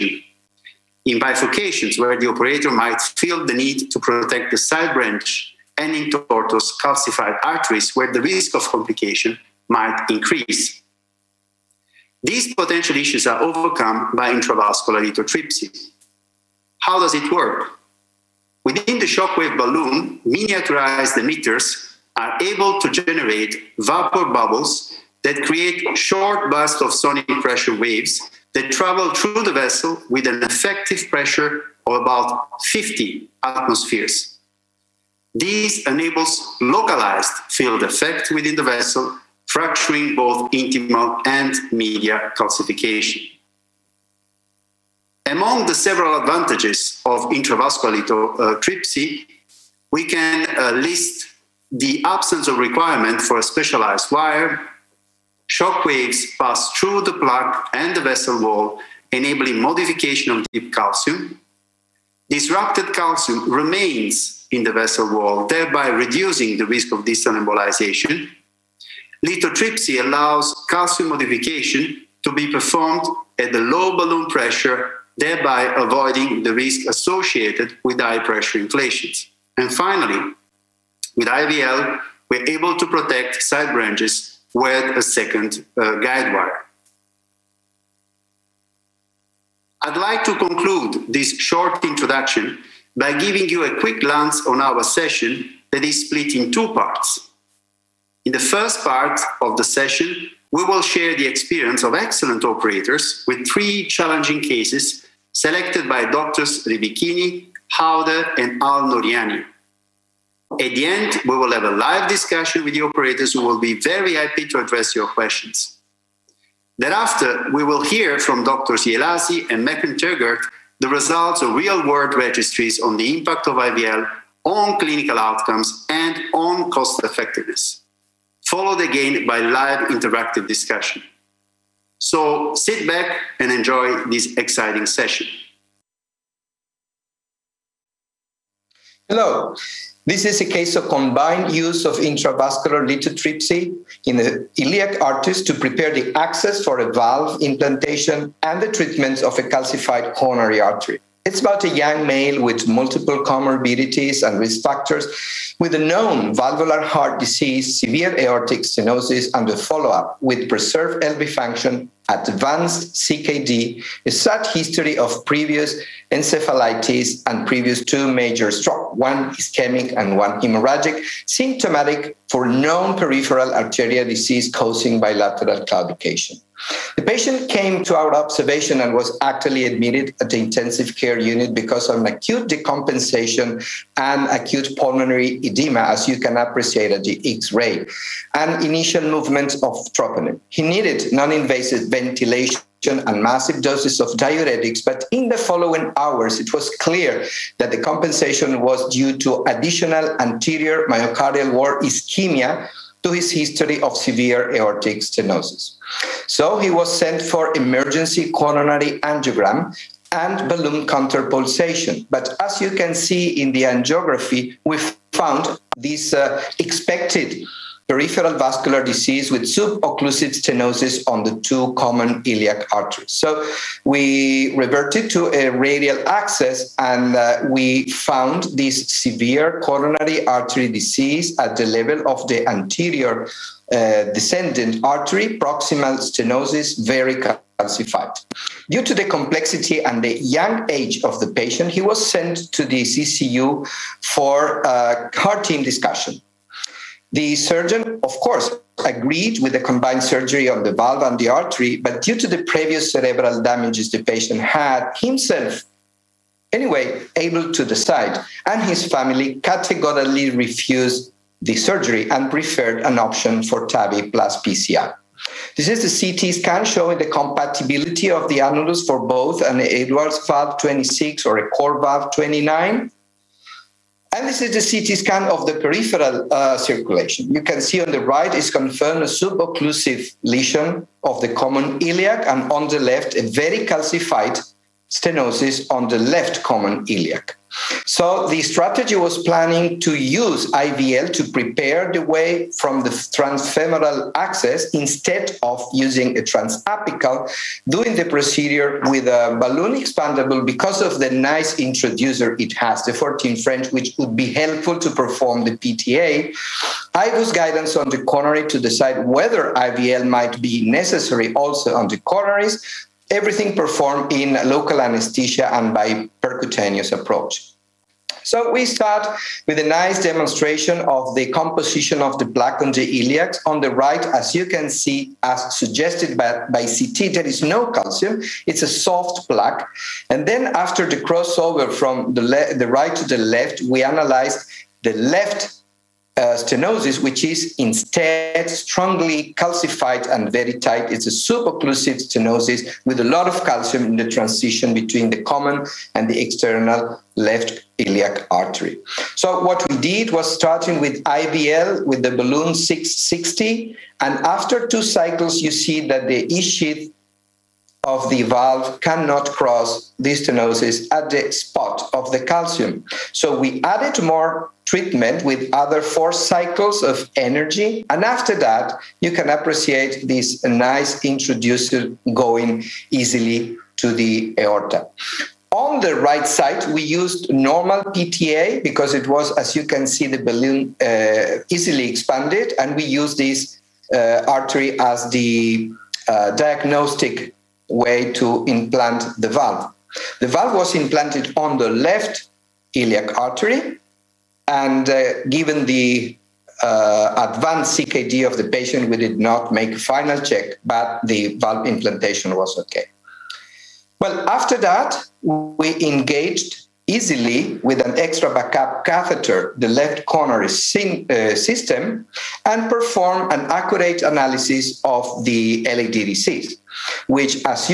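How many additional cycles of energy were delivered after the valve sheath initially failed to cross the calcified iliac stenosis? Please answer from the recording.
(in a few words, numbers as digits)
4.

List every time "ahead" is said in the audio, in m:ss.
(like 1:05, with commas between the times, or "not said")
not said.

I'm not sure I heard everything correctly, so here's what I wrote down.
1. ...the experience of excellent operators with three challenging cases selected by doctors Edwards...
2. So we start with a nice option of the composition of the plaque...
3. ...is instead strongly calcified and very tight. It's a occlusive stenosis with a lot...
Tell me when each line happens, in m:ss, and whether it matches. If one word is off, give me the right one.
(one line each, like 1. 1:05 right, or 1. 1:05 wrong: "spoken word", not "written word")
1. 1:41 wrong: "Ribichini", not "Edwards"
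2. 5:18 wrong: "demonstration", not "option"
3. 5:37 right.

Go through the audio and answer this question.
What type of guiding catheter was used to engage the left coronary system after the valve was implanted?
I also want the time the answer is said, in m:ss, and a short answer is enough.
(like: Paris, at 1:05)
extra backup catheter, at 6:47.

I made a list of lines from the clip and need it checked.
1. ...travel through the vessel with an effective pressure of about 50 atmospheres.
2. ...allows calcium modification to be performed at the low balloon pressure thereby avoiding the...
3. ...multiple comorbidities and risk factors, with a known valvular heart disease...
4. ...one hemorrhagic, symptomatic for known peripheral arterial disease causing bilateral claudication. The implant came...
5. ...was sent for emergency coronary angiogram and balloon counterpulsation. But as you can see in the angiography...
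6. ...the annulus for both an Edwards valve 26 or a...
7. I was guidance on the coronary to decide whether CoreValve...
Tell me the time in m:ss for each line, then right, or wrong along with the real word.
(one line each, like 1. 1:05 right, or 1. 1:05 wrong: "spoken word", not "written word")
1. 0:28 right
2. 1:10 right
3. 2:32 right
4. 2:50 wrong: "patient", not "implant"
5. 3:26 right
6. 4:28 right
7. 5:06 wrong: "IVL", not "CoreValve".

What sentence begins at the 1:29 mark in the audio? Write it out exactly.
I'd like to conclude this short introduction by giving you a quick glance on our session that is split in two parts.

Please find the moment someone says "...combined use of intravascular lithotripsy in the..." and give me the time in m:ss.
2:20.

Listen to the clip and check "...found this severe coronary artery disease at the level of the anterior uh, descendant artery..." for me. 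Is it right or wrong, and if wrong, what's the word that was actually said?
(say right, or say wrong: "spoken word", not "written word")
right.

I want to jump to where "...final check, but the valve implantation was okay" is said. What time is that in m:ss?
6:39.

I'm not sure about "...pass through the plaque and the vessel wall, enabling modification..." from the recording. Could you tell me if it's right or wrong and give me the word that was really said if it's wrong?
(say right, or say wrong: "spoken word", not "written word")
right.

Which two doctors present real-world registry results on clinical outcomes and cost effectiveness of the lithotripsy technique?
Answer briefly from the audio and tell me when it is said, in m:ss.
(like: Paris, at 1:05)
Ielasi and McIntyre, at 1:58.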